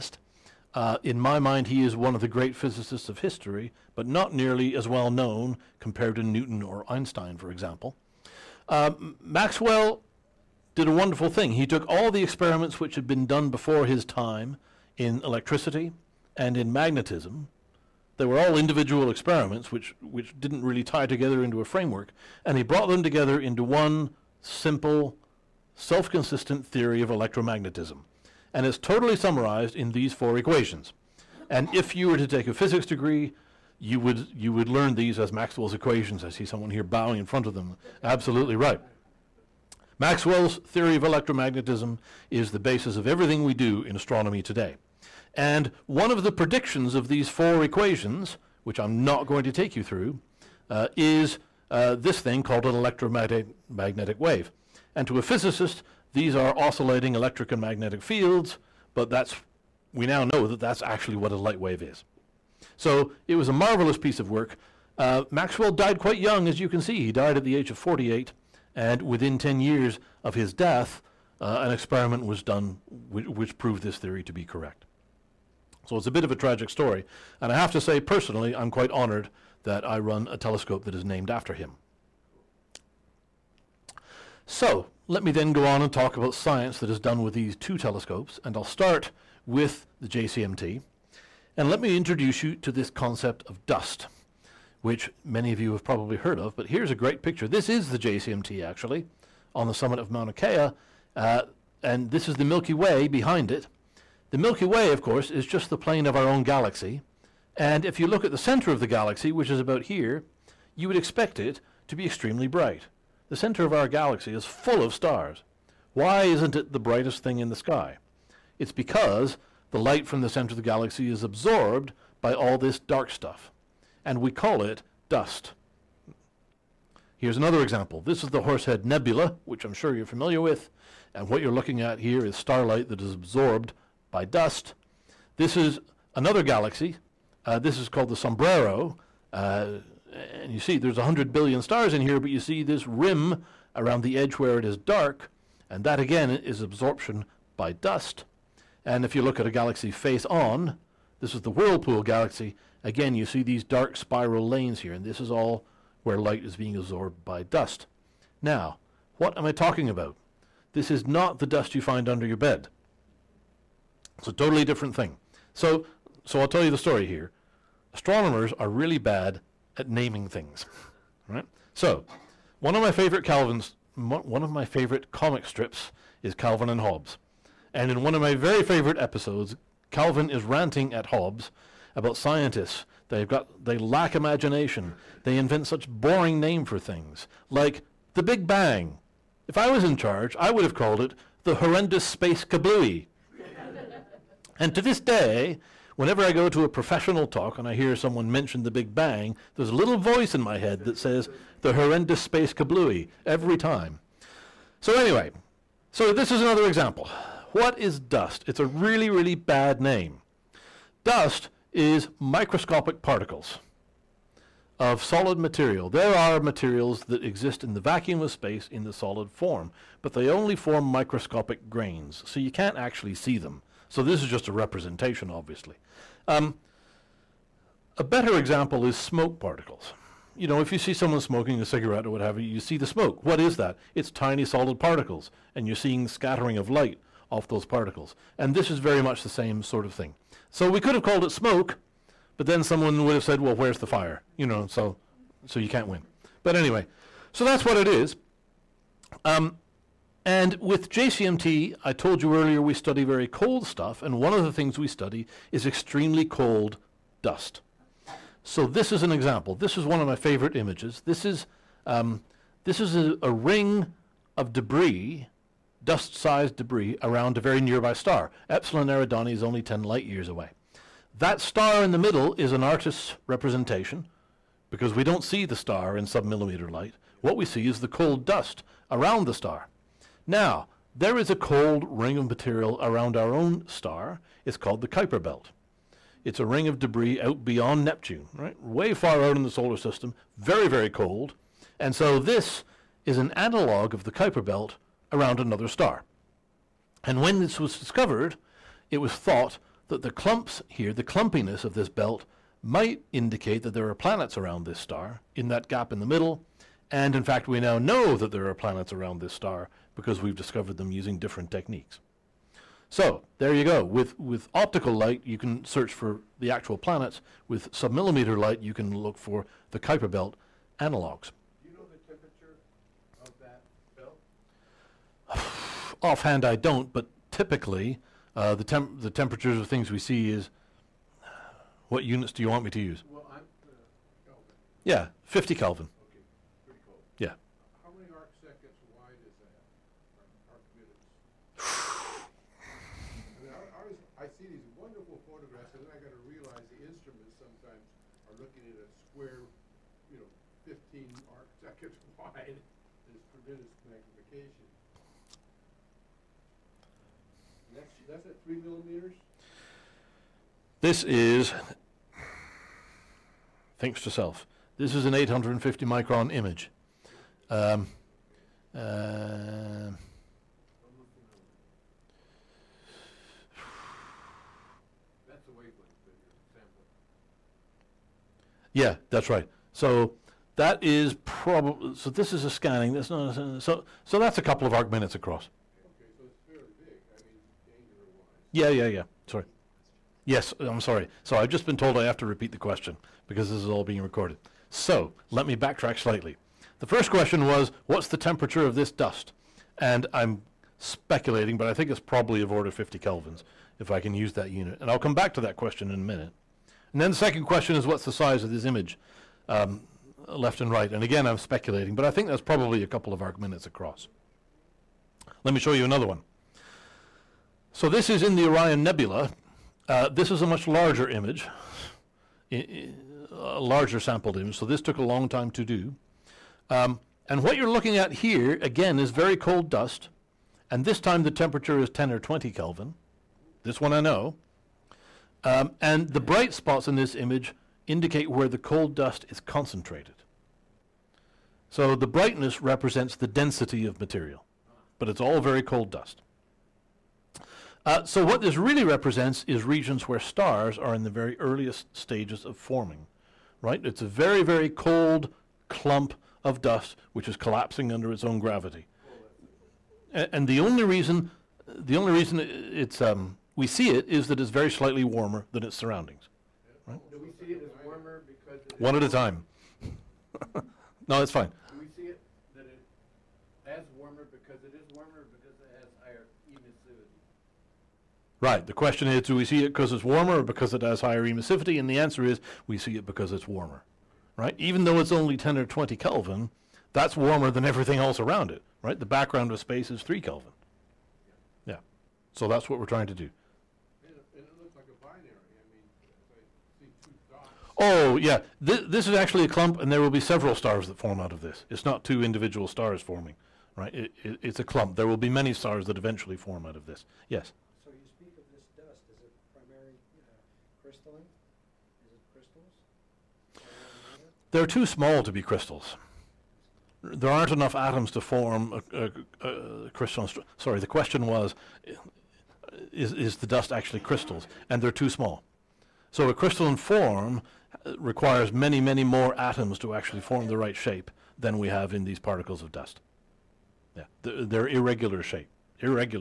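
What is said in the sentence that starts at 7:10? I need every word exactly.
And this time the temperature is 10 or 20 Kelvin.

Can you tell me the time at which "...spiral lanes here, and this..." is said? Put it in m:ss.
2:33.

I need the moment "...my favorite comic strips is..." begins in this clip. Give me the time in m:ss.
2:54.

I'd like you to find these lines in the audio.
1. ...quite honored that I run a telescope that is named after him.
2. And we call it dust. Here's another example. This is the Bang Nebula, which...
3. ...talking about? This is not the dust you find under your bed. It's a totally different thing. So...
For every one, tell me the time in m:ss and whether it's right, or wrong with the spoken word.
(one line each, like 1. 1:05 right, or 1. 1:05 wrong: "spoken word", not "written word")
1. 1:18 right
2. 2:04 wrong: "Horsehead", not "Bang"
3. 2:39 right.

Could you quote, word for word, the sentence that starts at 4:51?
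And so this is an analog of the Kuiper Belt around another star.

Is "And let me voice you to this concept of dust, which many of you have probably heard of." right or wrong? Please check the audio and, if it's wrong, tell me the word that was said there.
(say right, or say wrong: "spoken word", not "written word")
wrong: "introduce", not "voice".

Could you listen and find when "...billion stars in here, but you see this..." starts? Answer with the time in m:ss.
2:21.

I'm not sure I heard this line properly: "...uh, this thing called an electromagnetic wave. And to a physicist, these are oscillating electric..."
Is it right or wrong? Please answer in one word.
right.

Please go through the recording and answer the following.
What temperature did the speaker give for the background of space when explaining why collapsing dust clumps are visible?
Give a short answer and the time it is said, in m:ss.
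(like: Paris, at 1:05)
3 Kelvin, at 8:10.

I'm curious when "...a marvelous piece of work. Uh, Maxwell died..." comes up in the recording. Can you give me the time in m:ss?
1:03.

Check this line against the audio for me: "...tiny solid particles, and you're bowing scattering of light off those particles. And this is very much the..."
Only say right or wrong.
wrong.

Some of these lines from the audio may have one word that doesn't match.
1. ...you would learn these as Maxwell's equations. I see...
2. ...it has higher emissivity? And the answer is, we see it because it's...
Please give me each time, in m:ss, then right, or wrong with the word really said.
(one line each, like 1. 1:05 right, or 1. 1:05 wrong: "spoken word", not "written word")
1. 0:34 right
2. 8:00 right.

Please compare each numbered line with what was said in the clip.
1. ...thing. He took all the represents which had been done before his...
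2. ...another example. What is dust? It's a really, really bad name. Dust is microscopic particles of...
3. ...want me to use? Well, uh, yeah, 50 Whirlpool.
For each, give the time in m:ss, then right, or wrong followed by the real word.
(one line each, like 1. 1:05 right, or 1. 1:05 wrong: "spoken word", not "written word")
1. 0:11 wrong: "experiments", not "represents"
2. 3:26 right
3. 5:32 wrong: "Kelvin", not "Whirlpool".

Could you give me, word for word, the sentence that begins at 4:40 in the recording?
Now, there is a cold ring of material around our own star.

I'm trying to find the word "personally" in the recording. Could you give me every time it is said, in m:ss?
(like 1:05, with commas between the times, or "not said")
1:18.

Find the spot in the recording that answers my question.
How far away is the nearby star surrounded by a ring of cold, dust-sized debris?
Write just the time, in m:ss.
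4:29.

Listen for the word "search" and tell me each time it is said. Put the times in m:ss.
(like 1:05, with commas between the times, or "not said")
5:15.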